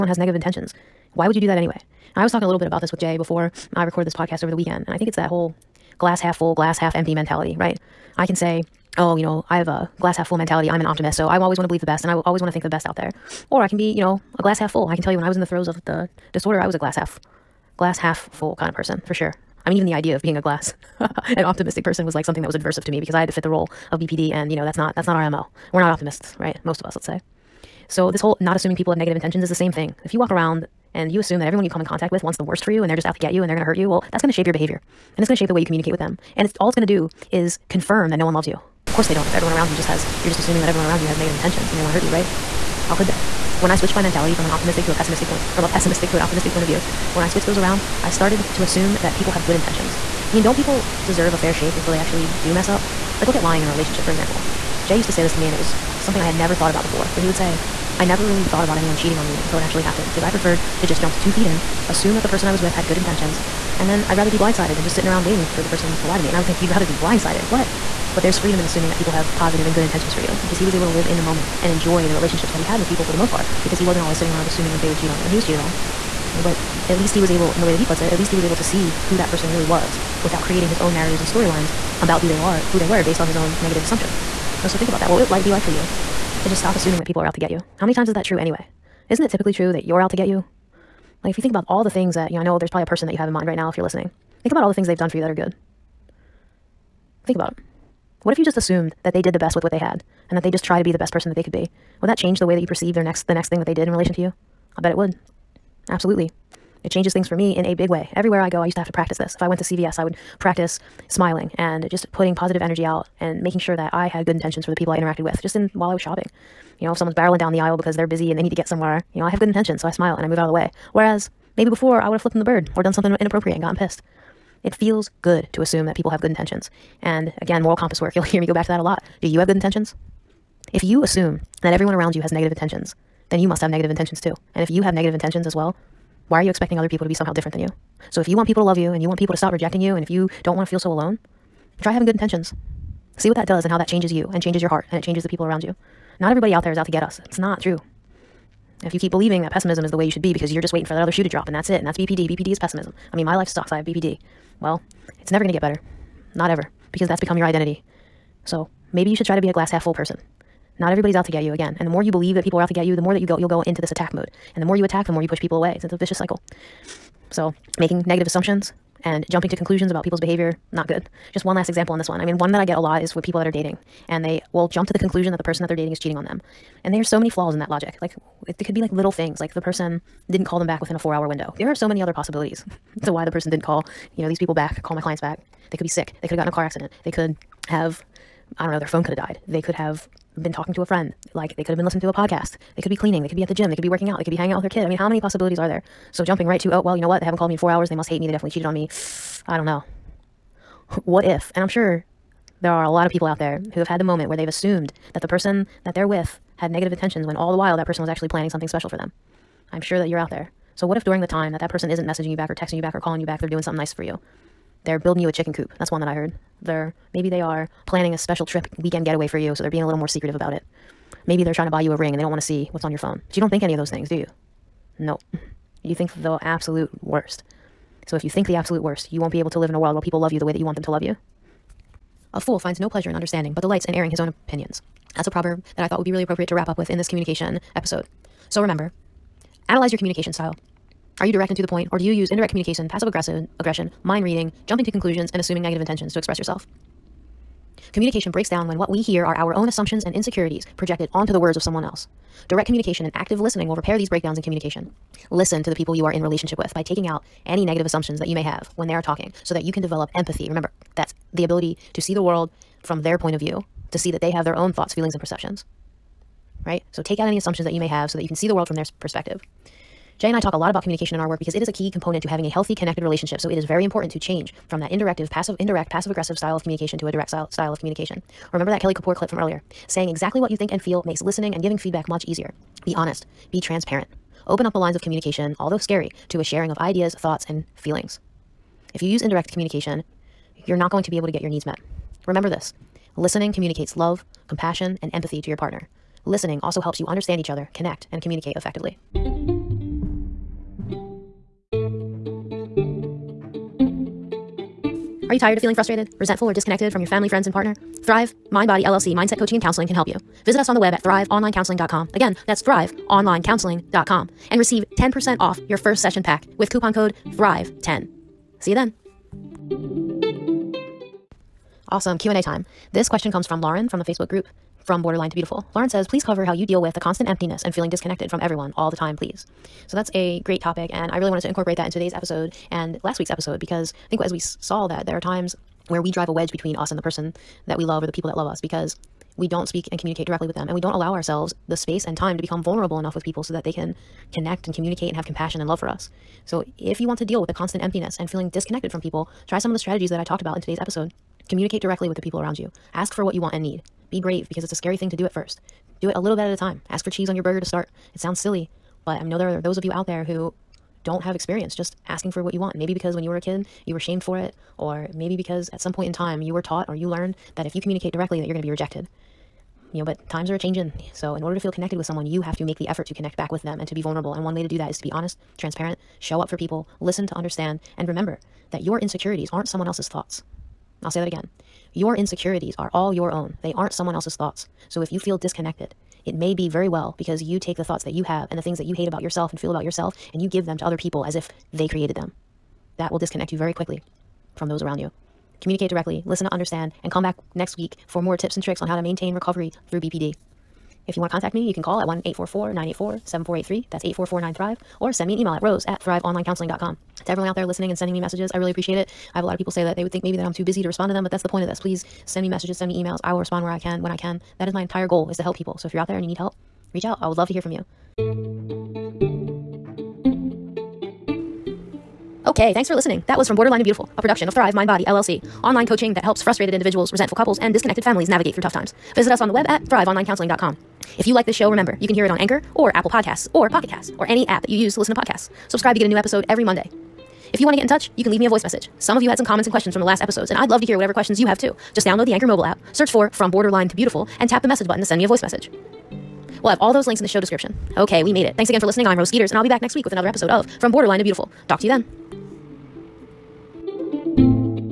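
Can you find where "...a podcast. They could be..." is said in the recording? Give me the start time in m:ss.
3:12.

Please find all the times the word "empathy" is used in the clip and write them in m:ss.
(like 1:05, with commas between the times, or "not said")
4:20, 4:55.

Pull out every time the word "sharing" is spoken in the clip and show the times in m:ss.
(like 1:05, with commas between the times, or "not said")
4:46.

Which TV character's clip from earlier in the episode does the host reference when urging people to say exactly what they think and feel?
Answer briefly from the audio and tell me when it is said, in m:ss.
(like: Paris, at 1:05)
Kelly Kapoor, at 4:38.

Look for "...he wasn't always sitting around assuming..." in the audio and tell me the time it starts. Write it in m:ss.
1:13.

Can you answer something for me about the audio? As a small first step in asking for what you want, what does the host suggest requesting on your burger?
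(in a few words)
Cheese.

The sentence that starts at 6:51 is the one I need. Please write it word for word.
Please send me messages, send me emails.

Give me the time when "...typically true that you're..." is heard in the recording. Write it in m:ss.
1:29.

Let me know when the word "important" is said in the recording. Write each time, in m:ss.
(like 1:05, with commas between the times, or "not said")
4:33.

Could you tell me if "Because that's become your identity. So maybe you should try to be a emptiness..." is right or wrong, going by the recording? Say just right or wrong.
wrong.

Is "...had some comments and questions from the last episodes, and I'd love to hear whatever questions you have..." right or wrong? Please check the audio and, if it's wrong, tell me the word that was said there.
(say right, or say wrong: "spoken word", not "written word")
right.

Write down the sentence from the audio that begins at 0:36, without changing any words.
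And it's all it's going to do is confirm that no one loves you.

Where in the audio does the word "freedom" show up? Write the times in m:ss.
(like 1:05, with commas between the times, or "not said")
1:08.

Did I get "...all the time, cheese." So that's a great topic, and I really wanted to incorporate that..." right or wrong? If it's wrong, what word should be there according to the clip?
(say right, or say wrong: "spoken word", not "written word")
wrong: "please", not "cheese".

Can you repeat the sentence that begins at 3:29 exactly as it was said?
I'm sure that you're out there.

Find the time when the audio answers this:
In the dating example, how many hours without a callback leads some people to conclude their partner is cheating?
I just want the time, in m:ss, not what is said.
3:00.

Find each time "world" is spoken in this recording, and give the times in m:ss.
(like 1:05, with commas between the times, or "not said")
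3:49, 4:22, 4:28.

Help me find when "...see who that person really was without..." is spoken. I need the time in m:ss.
1:18.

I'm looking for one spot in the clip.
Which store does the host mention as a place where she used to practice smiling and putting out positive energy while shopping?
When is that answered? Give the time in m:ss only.
1:49.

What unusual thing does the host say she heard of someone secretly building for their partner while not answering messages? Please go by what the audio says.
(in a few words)
A chicken coop.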